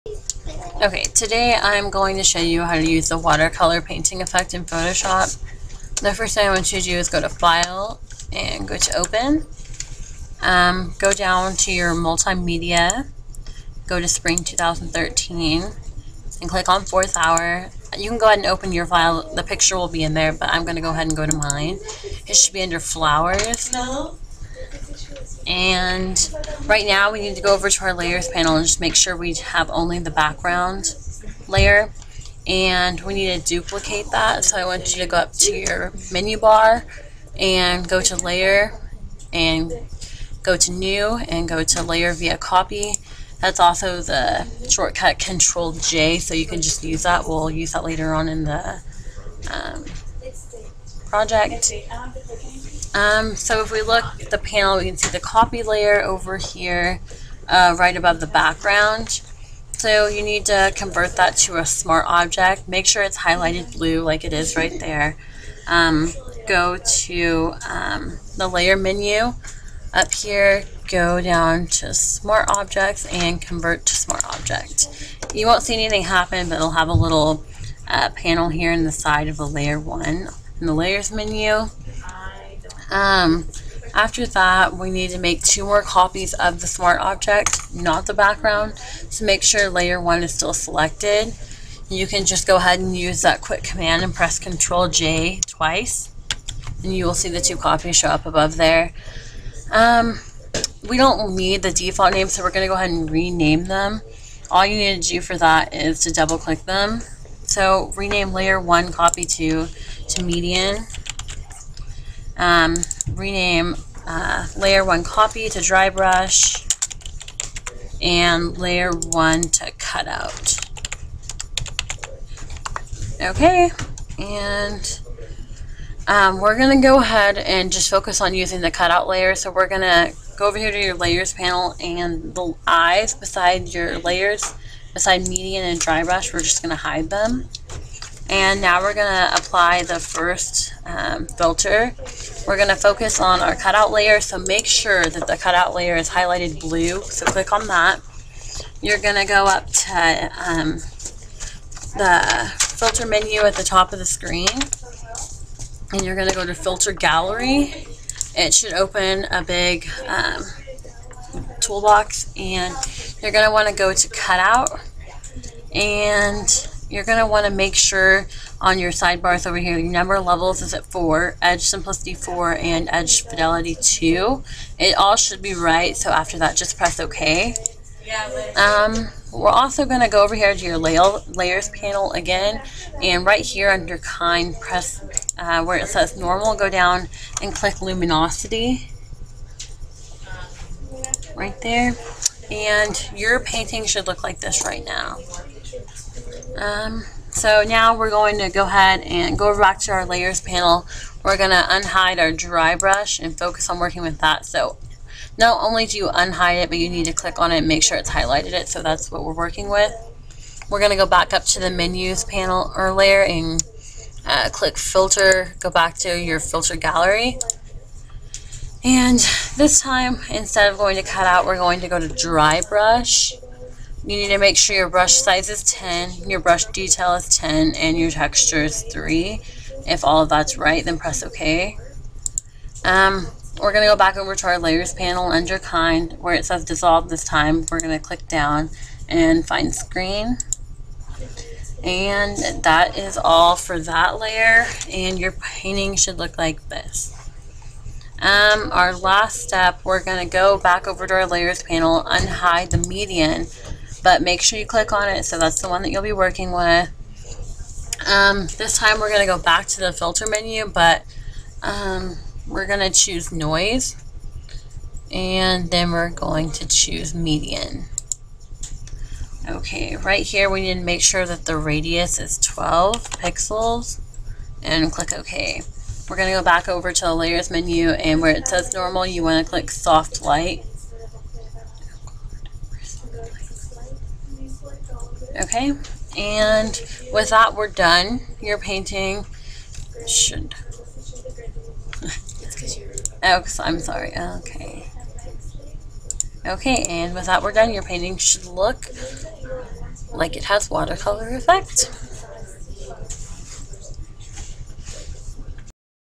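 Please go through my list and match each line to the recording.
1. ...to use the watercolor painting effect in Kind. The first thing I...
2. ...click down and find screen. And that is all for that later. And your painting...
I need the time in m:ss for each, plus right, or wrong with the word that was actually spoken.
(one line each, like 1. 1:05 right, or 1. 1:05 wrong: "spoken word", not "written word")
1. 0:02 wrong: "Photoshop", not "Kind"
2. 3:58 wrong: "layer", not "later".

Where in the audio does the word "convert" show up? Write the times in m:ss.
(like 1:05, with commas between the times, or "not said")
1:00, 1:13.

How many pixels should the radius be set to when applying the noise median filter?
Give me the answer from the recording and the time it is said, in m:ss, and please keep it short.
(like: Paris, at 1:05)
12, at 4:32.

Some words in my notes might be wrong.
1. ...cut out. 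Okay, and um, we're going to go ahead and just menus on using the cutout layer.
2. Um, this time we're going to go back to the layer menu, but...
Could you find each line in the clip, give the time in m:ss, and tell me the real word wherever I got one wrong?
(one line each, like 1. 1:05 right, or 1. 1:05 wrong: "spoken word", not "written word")
1. 1:59 wrong: "focus", not "menus"
2. 4:18 wrong: "filter", not "layer".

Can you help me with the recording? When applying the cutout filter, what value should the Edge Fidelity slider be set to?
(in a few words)
2.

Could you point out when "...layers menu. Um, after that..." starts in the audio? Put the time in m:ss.
1:20.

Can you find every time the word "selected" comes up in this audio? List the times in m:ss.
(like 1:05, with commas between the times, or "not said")
1:30.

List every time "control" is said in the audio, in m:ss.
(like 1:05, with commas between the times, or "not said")
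0:45, 1:34.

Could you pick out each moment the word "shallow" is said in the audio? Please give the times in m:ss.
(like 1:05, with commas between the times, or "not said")
not said.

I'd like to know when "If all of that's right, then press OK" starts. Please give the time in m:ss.
3:49.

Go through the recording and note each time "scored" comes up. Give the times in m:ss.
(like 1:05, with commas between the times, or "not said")
not said.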